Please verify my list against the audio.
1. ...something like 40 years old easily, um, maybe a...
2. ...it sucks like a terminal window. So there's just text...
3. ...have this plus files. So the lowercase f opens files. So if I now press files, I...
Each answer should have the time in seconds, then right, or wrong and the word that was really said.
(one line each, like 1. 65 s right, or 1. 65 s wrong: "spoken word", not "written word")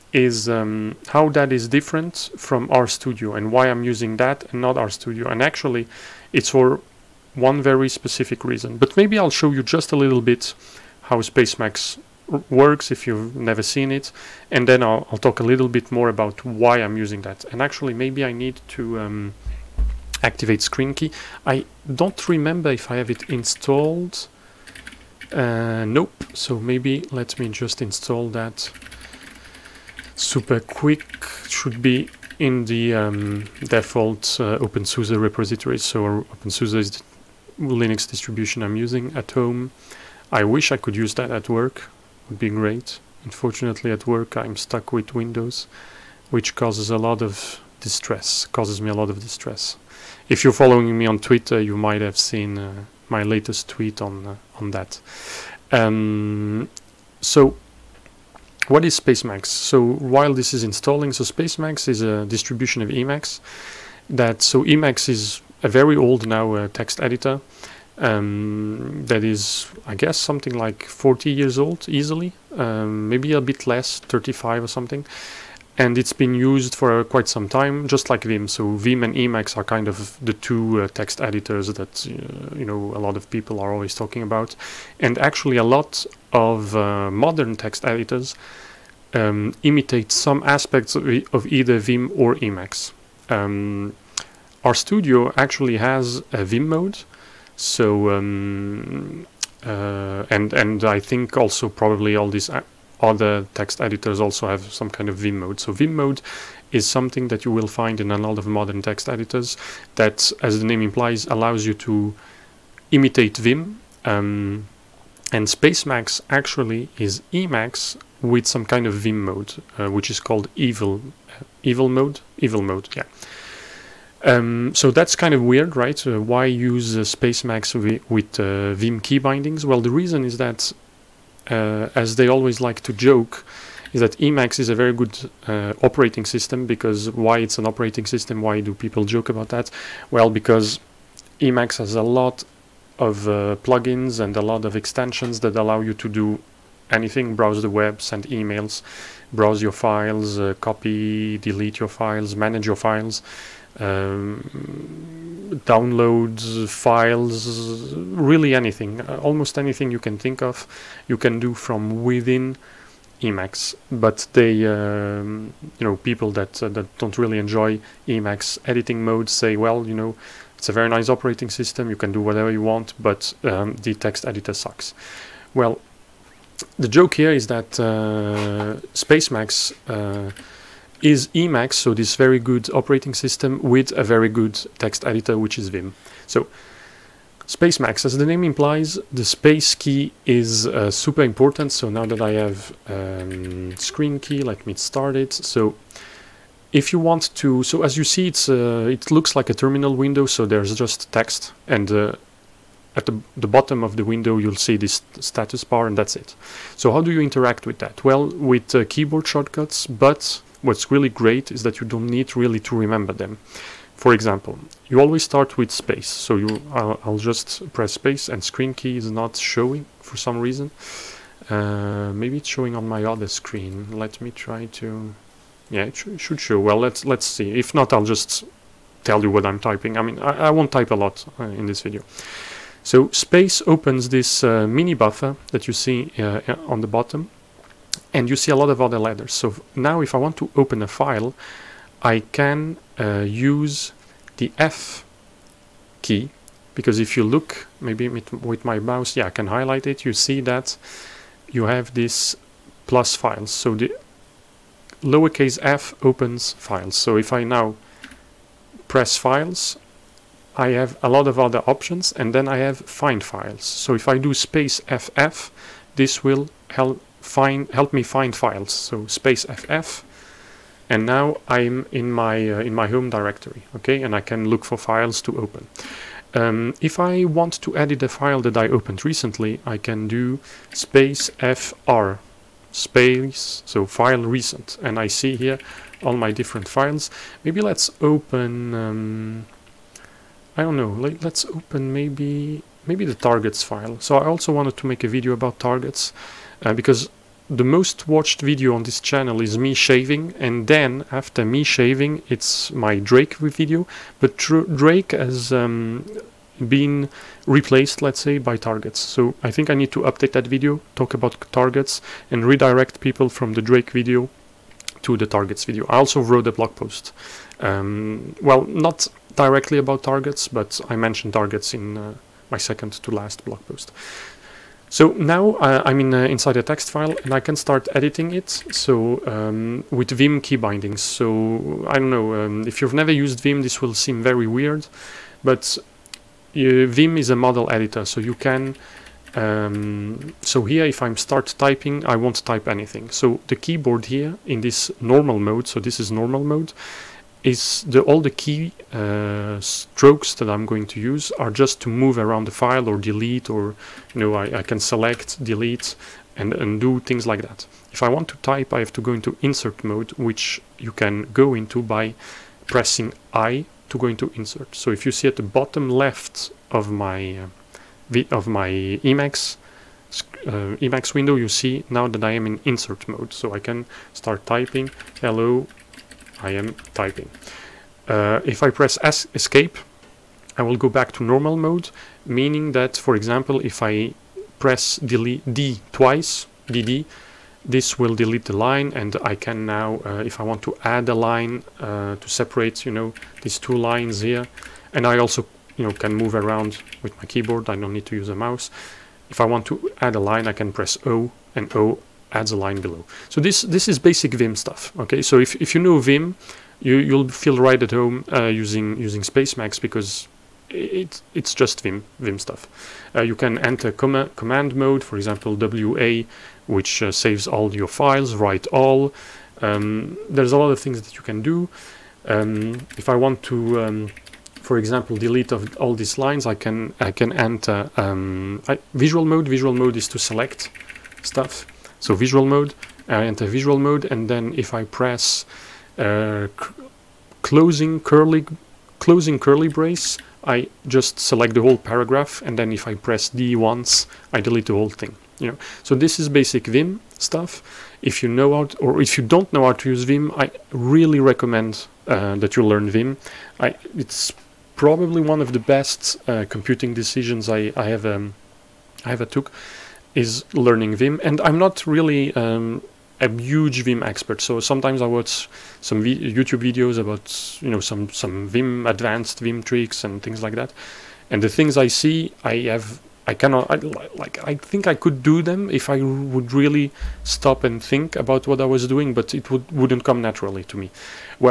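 1. 70 s right
2. 198 s wrong: "looks", not "sucks"
3. 251 s right.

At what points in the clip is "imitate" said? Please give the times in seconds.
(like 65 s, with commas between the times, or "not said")
89 s, 112 s.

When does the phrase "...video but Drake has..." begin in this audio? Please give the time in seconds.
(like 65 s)
303 s.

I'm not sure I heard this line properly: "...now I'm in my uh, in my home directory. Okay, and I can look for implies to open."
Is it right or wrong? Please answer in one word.
wrong.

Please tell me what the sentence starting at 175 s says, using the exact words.
Well, the joke here is that uh, Spacemacs.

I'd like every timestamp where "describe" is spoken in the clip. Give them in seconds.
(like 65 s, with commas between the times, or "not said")
not said.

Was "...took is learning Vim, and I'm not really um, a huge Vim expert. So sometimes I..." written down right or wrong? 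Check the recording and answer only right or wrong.
right.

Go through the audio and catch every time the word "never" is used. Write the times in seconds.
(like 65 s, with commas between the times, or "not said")
13 s, 332 s.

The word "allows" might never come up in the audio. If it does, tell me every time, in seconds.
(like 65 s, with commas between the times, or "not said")
111 s, 145 s.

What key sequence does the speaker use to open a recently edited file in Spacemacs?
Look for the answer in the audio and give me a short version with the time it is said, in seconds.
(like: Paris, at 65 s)
space fr, at 280 s.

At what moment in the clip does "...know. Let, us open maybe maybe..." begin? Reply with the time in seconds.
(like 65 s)
290 s.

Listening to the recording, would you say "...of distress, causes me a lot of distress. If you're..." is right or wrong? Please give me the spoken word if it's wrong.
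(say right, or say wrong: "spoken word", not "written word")
right.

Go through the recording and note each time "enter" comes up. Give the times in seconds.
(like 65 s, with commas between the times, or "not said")
413 s, 427 s, 433 s.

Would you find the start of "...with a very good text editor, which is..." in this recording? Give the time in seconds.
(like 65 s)
183 s.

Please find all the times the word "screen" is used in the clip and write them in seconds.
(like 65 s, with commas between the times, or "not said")
20 s, 193 s, 218 s, 223 s.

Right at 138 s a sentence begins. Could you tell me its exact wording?
Why do people joke about that?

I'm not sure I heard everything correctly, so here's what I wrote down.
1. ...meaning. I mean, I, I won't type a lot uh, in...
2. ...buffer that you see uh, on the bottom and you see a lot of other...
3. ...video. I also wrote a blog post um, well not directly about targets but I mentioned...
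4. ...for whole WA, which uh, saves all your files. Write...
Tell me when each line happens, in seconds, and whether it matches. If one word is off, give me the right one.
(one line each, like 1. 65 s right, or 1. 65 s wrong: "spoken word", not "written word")
1. 229 s wrong: "typing", not "meaning"
2. 234 s right
3. 315 s right
4. 415 s wrong: "example", not "whole".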